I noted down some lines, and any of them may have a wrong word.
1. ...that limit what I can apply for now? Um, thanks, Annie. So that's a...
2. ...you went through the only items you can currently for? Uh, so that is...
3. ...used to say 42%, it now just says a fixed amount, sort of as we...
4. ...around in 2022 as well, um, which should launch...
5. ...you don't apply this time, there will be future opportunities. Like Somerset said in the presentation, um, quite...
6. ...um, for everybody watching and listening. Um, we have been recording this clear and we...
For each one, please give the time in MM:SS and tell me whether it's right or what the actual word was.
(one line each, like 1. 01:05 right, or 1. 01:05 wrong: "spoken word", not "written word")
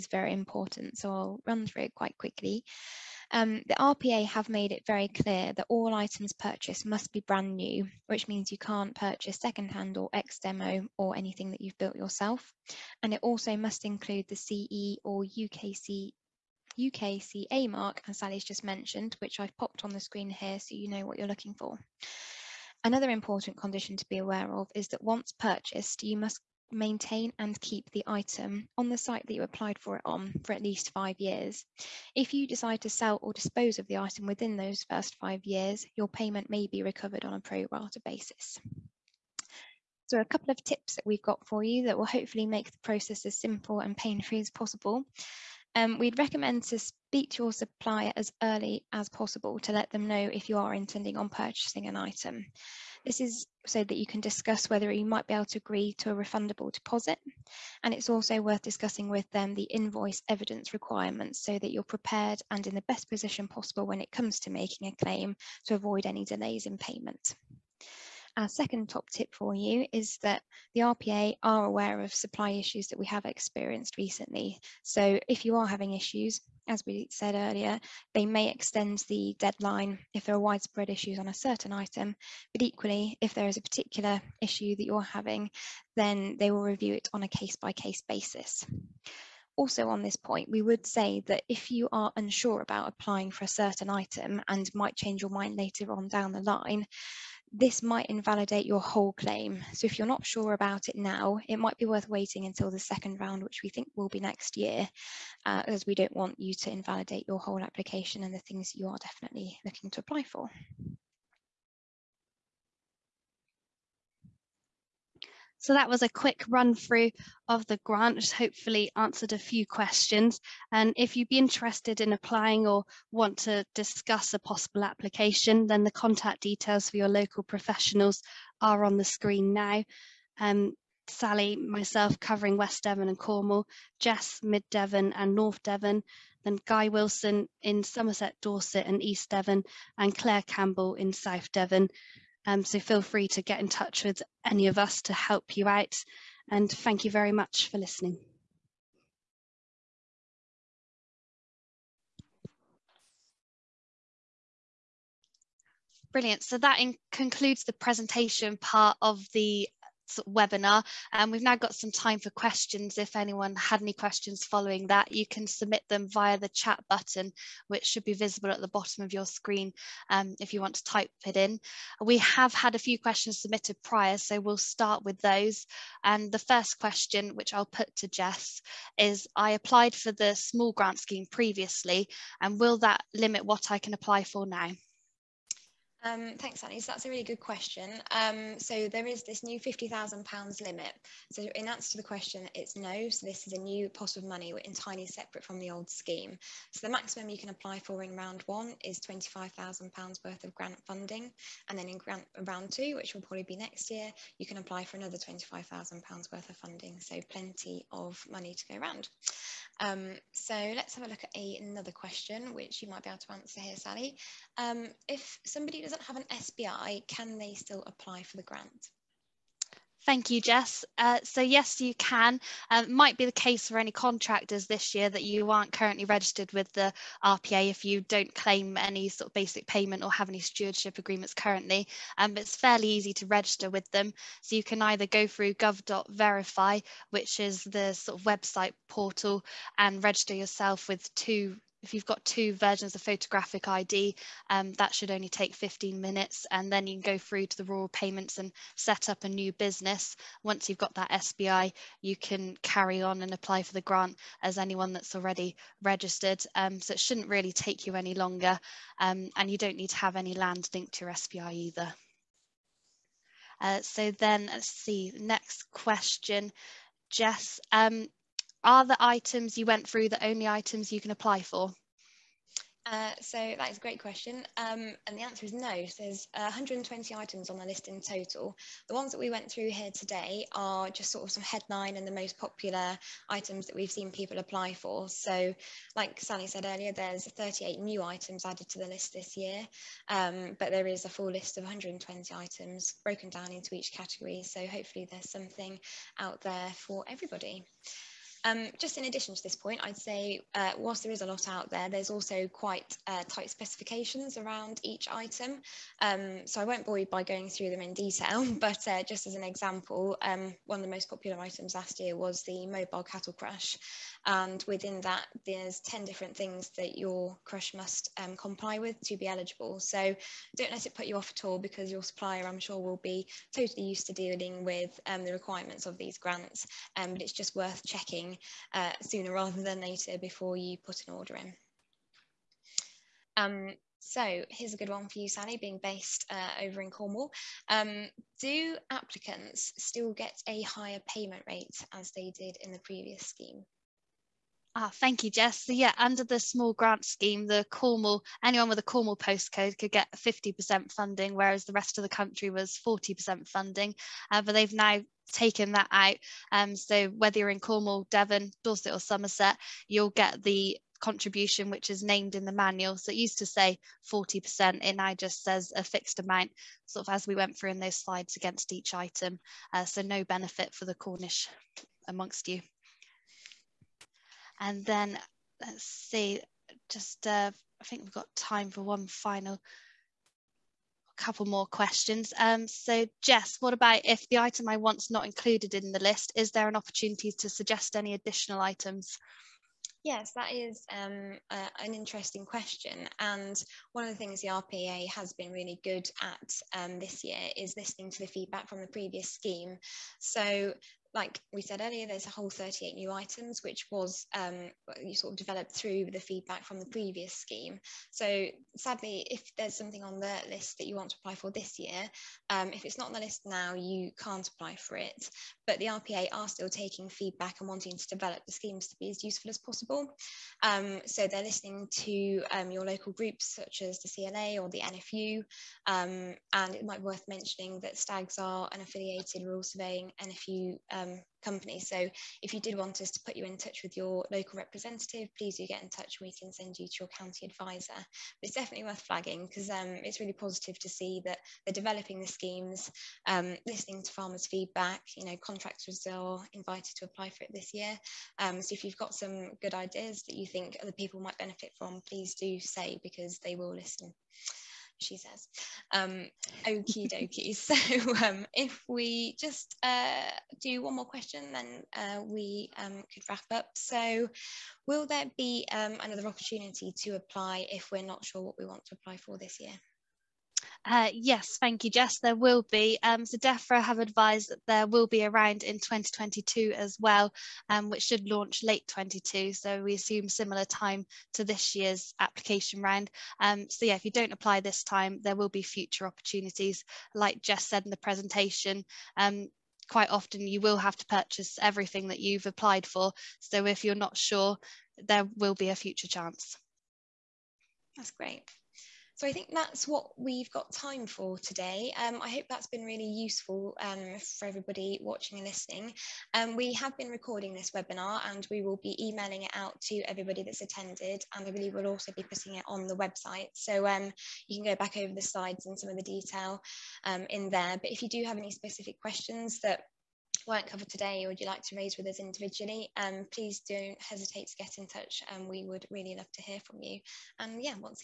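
1. 03:02 right
2. 04:29 wrong: "apply", not "currently"
3. 06:03 wrong: "40", not "42"
4. 07:55 right
5. 08:04 wrong: "Jess", not "Somerset"
6. 08:23 wrong: "webinar", not "clear".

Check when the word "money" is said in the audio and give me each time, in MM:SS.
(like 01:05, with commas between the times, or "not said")
03:14, 03:28.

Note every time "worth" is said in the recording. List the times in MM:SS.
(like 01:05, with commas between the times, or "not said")
00:58, 01:41, 03:20, 03:26, 05:27, 07:07, 07:18.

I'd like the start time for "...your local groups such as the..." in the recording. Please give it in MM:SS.
07:02.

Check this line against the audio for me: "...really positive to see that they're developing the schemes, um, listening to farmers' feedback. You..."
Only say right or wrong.
right.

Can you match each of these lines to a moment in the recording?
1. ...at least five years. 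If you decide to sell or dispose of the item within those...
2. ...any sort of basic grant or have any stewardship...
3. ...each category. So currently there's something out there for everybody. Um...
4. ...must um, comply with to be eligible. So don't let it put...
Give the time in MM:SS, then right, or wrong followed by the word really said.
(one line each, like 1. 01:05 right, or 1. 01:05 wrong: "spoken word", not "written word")
1. 00:30 right
2. 03:48 wrong: "payment", not "grant"
3. 04:53 wrong: "hopefully", not "currently"
4. 05:17 right.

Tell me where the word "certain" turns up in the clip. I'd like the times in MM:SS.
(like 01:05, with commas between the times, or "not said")
01:21, 01:33.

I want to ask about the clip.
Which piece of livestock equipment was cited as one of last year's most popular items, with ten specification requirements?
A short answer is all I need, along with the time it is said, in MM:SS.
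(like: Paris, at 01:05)
mobile cattle crush, at 05:12.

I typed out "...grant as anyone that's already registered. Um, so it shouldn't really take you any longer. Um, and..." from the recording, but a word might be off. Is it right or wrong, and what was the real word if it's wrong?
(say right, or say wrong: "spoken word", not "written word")
right.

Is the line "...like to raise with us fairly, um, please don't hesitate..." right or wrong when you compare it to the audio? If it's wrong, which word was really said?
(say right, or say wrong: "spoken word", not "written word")
wrong: "individually", not "fairly".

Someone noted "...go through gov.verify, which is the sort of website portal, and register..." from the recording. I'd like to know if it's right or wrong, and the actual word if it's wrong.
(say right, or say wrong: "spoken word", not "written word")
right.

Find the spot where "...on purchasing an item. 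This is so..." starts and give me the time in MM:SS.
00:51.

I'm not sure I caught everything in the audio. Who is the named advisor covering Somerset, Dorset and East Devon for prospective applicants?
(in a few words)
Guy Wilson.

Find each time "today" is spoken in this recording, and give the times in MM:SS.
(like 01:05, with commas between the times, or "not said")
04:39, 08:21, 08:40.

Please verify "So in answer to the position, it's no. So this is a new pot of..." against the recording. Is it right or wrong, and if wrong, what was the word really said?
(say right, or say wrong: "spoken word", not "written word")
wrong: "question", not "position".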